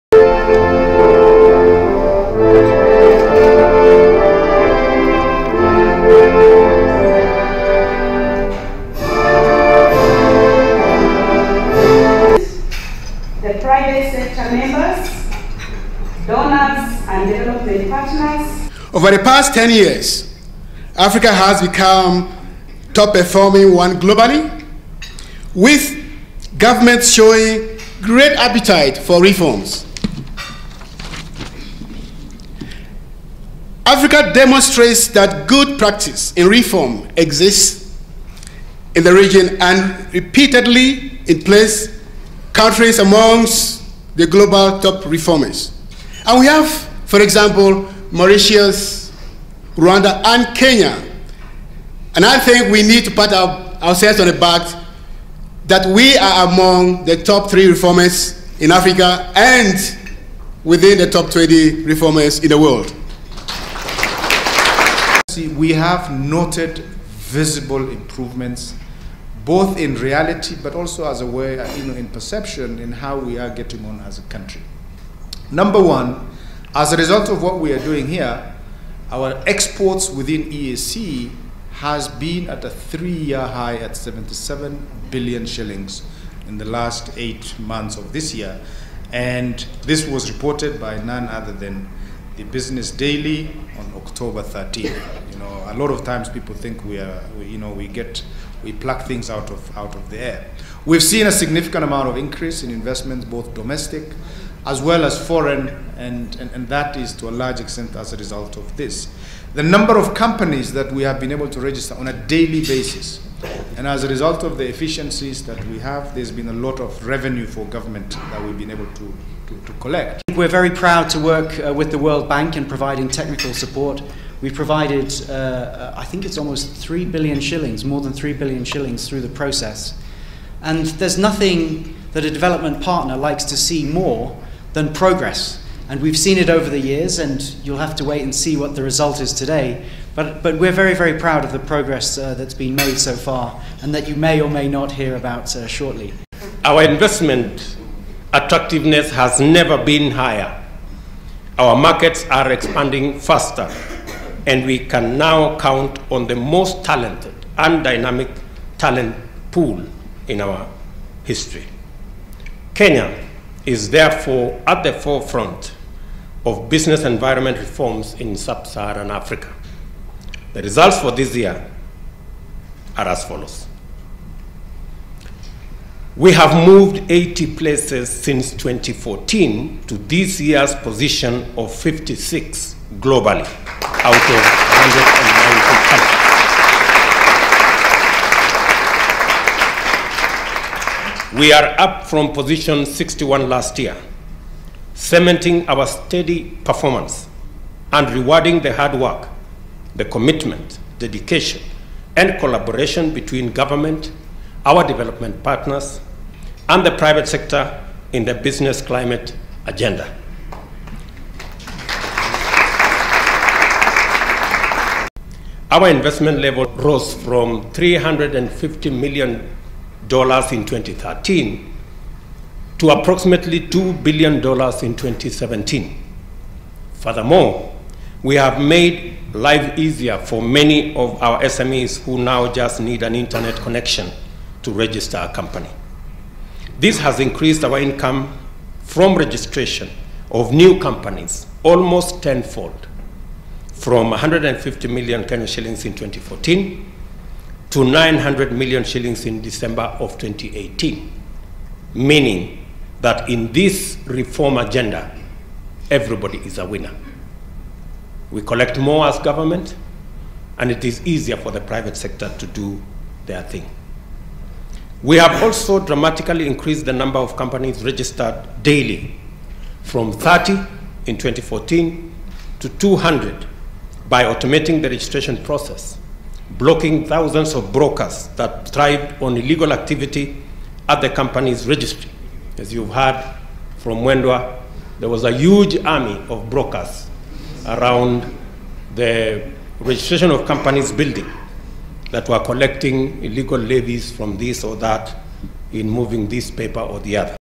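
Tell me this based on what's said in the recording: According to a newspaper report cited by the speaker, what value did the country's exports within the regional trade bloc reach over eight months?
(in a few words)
77 billion shillings.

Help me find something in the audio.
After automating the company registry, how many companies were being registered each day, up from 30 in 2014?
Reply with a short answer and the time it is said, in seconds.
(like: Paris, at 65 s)
200, at 272 s.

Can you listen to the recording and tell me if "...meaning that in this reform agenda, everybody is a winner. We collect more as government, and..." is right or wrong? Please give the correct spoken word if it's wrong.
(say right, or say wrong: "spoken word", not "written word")
right.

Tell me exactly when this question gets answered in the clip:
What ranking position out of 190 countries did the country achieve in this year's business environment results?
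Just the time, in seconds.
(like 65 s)
181 s.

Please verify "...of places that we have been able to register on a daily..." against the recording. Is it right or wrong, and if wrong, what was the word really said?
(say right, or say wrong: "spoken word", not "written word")
wrong: "companies", not "places".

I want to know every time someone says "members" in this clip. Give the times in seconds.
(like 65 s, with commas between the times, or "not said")
14 s.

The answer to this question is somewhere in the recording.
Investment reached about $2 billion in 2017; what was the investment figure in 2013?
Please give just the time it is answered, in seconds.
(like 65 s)
217 s.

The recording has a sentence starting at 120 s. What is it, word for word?
We're very proud to work uh, with the World Bank in providing technical support.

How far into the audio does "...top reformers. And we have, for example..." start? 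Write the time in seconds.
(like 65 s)
44 s.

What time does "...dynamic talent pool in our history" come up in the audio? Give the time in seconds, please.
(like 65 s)
157 s.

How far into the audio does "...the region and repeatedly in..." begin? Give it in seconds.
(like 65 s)
39 s.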